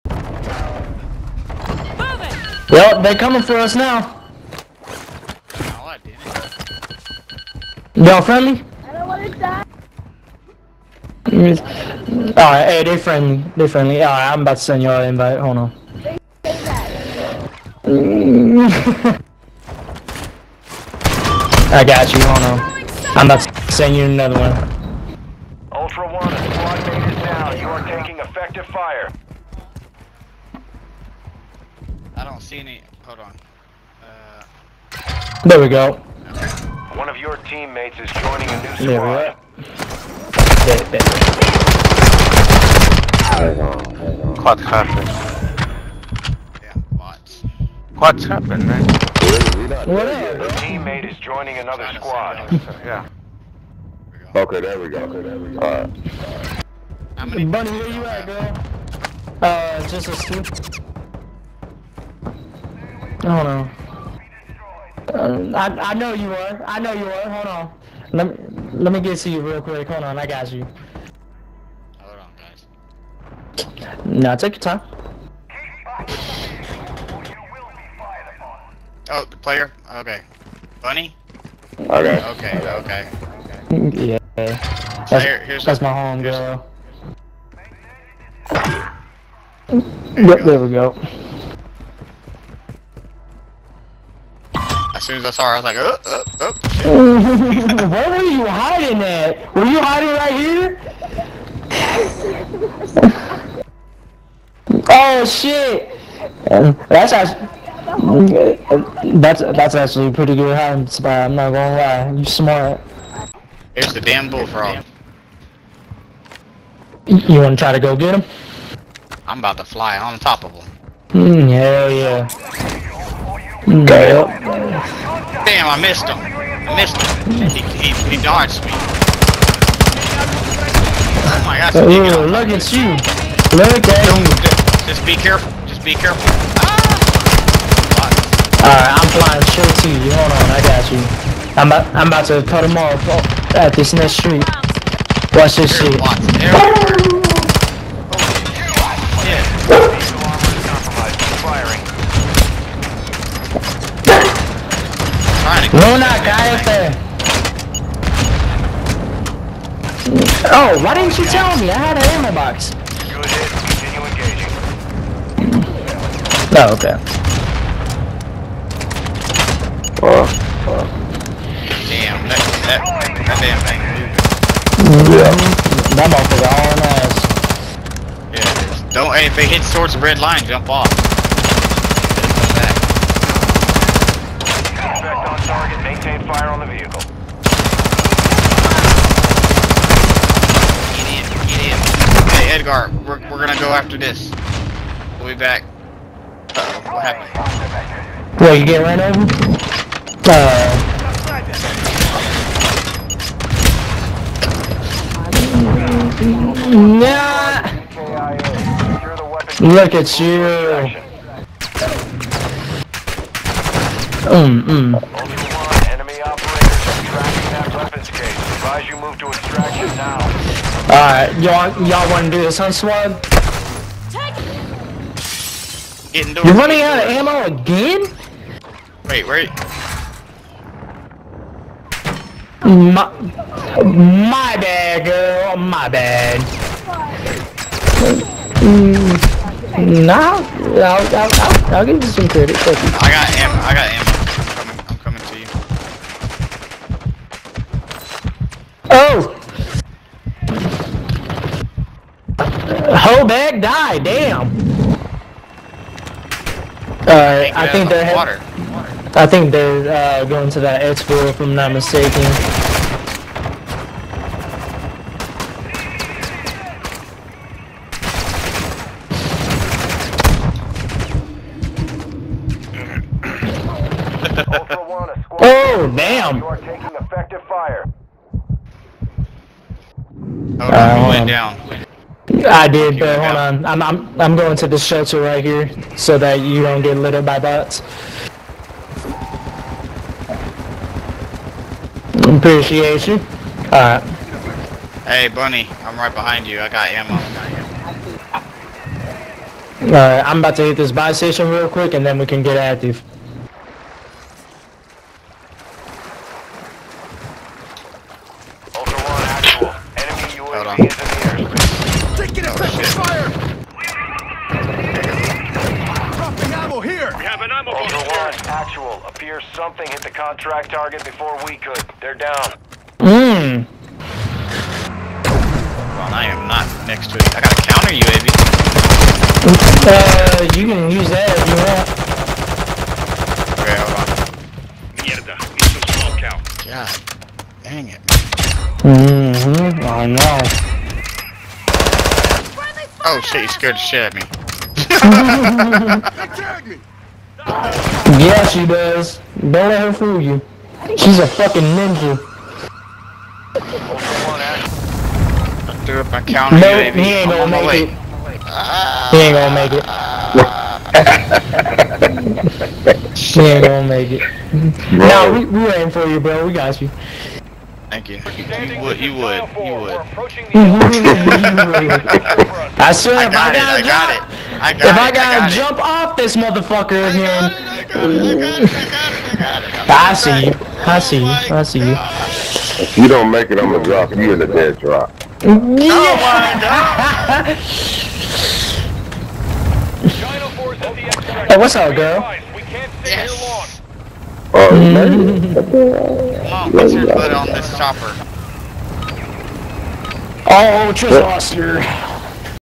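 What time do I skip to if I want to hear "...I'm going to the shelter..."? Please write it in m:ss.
4:44.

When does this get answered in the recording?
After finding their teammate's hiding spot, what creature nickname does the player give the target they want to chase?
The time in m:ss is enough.
1:54.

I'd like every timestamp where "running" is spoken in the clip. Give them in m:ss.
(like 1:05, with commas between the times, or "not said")
3:46.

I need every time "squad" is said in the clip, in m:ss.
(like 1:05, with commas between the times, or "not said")
0:26, 0:38, 0:51, 3:42.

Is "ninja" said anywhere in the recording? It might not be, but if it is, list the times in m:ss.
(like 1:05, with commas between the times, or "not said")
5:51.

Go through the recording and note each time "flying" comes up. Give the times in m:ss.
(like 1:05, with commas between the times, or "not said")
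2:19.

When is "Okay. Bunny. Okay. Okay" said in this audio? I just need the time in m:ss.
1:19.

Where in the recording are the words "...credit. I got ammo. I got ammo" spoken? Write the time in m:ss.
4:02.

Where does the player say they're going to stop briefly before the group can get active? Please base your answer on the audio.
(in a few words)
buy station.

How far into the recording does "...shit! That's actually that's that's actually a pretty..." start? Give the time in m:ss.
1:45.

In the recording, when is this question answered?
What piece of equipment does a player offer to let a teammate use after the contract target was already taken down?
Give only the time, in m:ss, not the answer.
5:27.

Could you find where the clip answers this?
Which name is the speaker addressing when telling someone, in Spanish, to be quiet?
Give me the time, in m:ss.
2:35.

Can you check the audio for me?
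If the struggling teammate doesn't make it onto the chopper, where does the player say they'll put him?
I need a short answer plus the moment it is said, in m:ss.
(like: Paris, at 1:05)
dead drop, at 6:24.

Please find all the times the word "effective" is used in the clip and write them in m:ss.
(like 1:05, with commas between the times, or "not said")
0:28, 4:36.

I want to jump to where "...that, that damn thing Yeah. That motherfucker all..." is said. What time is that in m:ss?
2:52.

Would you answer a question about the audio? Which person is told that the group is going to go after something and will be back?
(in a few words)
Edgar.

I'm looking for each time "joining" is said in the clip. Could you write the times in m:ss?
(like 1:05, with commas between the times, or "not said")
0:38, 0:51.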